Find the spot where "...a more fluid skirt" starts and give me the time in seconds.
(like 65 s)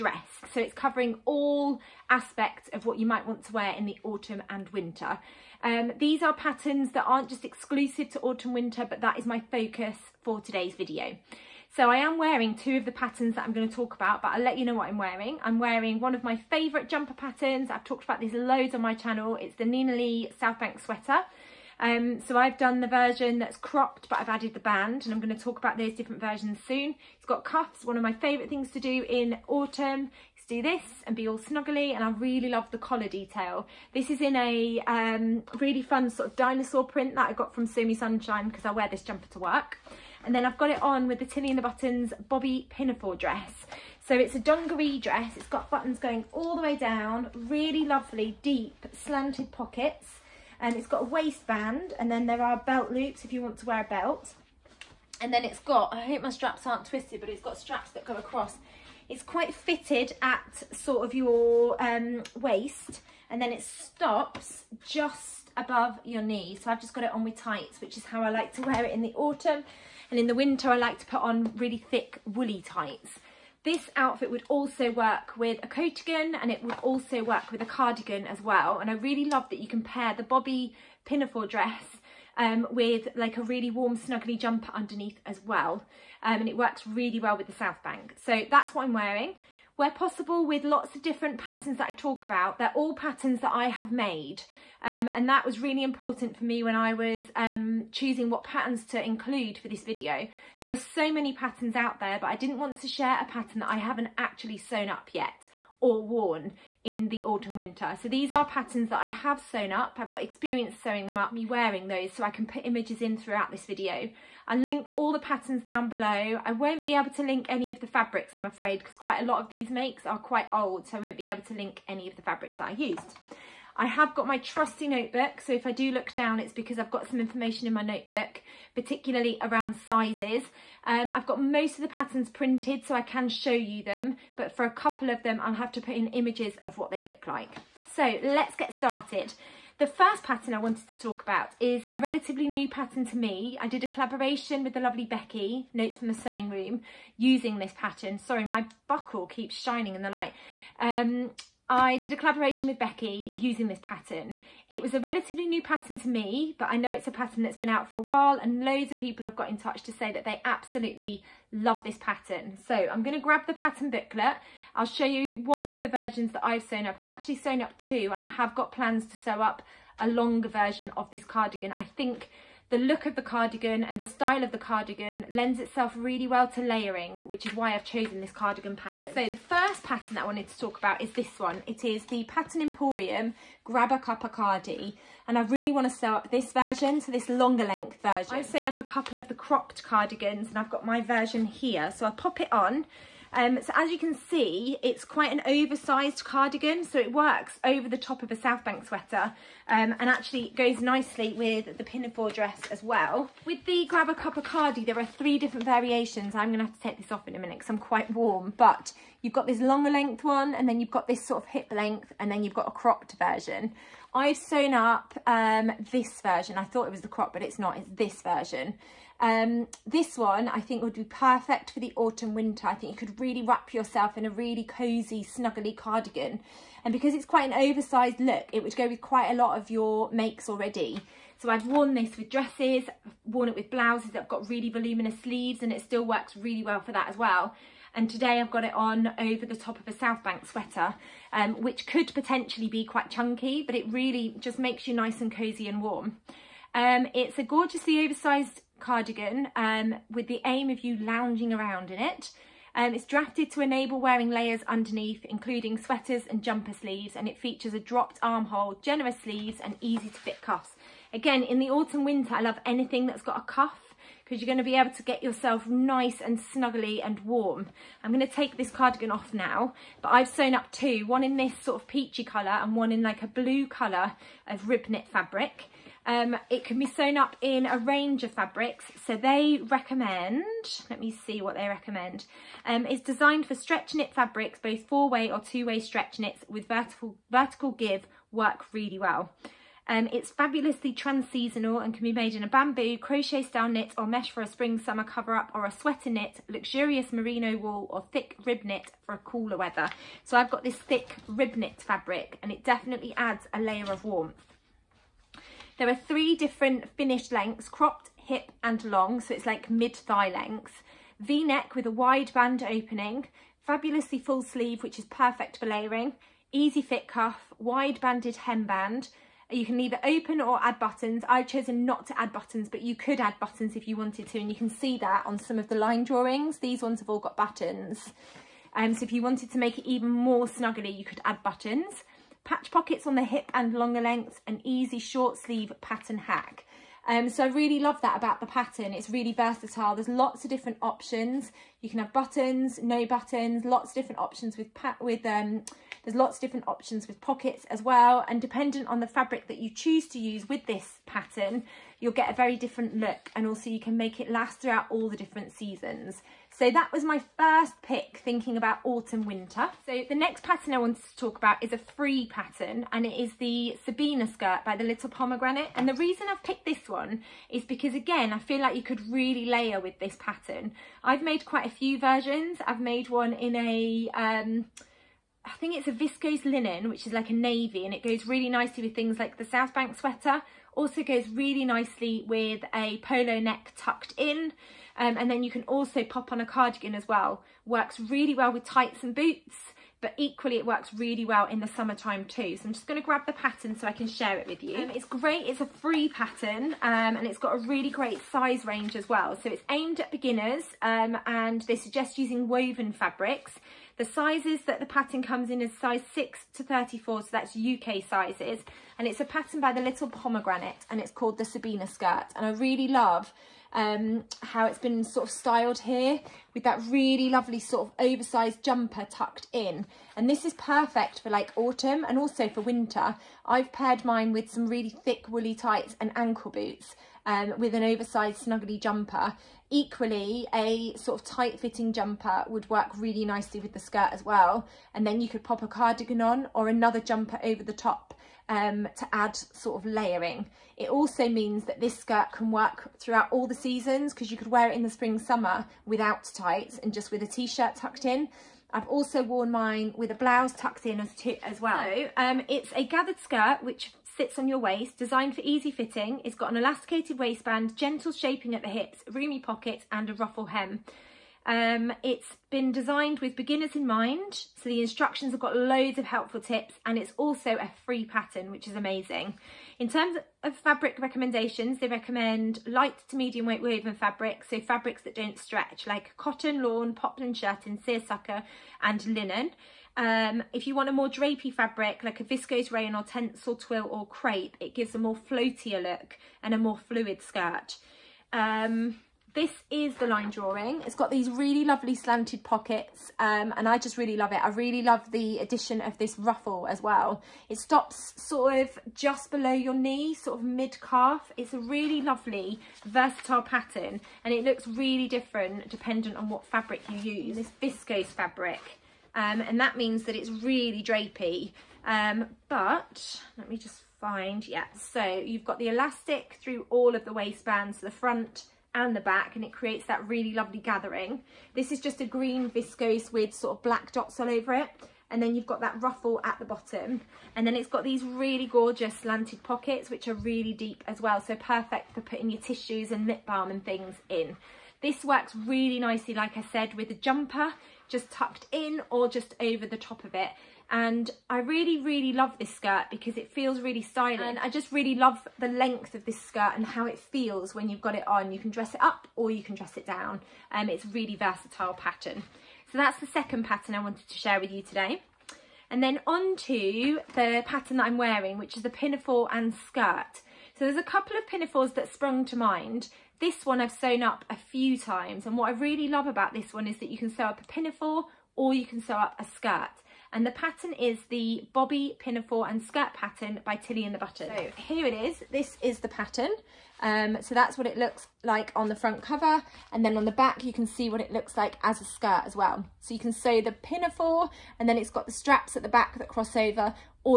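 486 s.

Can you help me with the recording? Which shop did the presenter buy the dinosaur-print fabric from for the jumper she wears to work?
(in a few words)
Sew Me Sunshine.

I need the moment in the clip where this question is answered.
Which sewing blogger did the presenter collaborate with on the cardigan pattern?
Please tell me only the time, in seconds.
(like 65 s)
145 s.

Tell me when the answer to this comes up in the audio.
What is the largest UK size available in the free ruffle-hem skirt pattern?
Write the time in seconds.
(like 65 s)
406 s.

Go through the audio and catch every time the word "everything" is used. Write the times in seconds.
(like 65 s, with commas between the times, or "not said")
not said.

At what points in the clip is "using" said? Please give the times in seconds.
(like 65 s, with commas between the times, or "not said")
147 s, 153 s, 402 s.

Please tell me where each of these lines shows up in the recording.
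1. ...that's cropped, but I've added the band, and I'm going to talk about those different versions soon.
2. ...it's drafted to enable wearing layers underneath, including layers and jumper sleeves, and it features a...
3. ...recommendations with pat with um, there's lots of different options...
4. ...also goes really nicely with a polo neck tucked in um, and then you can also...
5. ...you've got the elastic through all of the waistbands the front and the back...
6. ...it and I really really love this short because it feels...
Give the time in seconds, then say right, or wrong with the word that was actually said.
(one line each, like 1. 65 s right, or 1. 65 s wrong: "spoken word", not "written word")
1. 23 s right
2. 252 s wrong: "sweaters", not "layers"
3. 344 s wrong: "options", not "recommendations"
4. 380 s right
5. 515 s right
6. 540 s wrong: "skirt", not "short".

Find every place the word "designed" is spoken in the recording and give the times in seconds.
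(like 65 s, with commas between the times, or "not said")
283 s, 454 s, 462 s.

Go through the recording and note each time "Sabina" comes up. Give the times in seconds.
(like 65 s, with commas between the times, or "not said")
363 s, 411 s.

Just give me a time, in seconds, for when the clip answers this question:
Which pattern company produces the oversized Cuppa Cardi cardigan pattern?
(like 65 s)
182 s.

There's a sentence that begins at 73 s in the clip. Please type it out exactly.
This outfit would also work with a coatigan and it would also work with a cardigan as well.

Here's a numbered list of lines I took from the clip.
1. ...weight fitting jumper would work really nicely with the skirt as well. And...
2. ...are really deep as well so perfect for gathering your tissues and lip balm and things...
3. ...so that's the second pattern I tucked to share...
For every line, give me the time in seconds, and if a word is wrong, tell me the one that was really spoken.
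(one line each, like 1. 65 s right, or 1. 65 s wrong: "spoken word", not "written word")
1. 431 s wrong: "tight", not "weight"
2. 530 s wrong: "putting", not "gathering"
3. 552 s wrong: "wanted", not "tucked".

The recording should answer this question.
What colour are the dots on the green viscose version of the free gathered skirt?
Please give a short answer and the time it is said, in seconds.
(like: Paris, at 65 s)
black, at 523 s.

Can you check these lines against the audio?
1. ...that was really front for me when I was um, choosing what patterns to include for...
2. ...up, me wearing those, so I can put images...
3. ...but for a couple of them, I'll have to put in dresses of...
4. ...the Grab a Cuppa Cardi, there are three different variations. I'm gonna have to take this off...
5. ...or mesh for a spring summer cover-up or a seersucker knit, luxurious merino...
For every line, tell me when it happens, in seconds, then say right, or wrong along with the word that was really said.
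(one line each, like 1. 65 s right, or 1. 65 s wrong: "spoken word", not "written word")
1. 95 s wrong: "important", not "front"
2. 111 s right
3. 134 s wrong: "images", not "dresses"
4. 203 s right
5. 293 s wrong: "sweater", not "seersucker".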